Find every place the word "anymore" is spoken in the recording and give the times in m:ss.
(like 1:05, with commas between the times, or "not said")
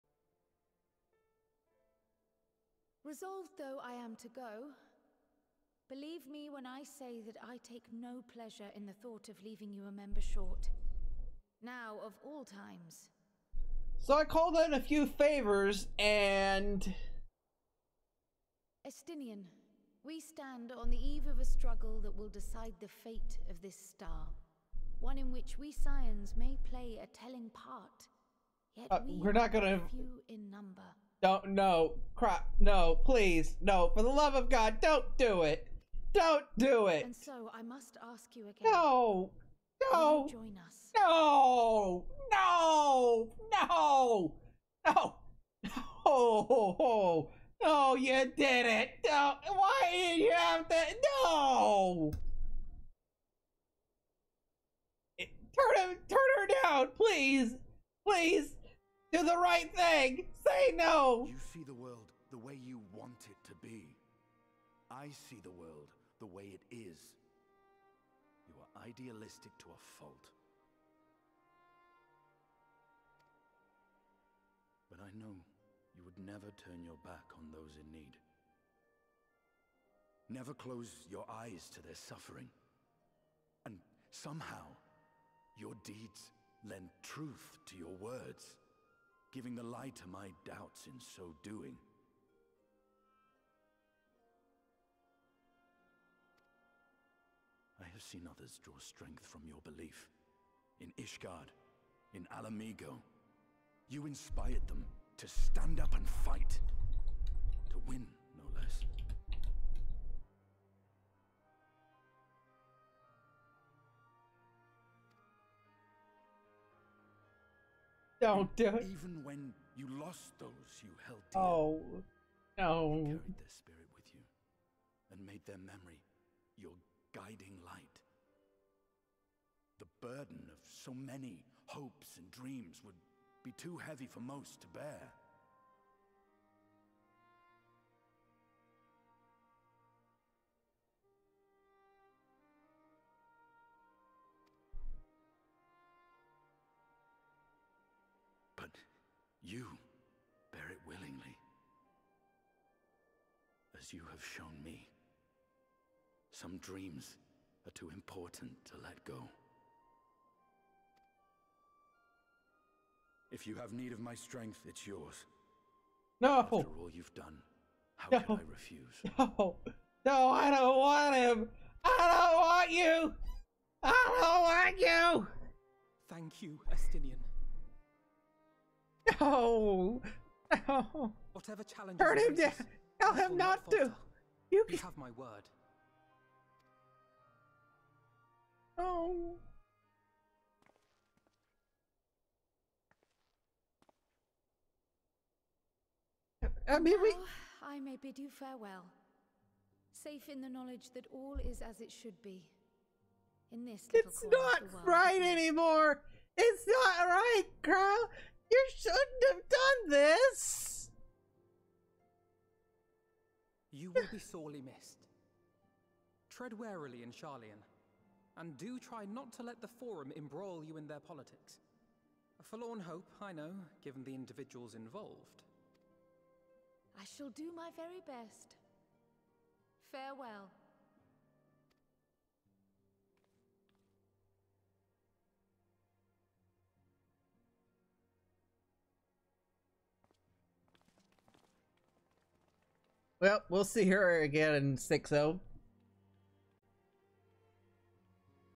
3:25.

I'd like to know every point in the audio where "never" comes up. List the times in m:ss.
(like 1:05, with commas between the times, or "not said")
1:16, 1:20.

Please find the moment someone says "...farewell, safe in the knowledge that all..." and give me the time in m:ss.
3:18.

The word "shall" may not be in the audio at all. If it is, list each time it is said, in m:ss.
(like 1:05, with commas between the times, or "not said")
3:47.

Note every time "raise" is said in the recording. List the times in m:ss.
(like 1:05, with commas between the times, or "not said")
not said.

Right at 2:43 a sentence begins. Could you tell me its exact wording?
If you have need of my strength, it's yours.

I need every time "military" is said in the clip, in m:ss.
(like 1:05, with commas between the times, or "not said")
not said.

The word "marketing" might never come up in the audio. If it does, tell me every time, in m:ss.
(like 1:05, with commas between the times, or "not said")
not said.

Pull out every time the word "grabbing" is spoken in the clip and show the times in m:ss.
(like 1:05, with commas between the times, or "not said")
not said.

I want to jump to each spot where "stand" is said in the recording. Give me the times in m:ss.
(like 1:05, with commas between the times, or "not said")
0:20, 1:45.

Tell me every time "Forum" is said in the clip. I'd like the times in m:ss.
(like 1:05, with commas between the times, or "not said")
3:39.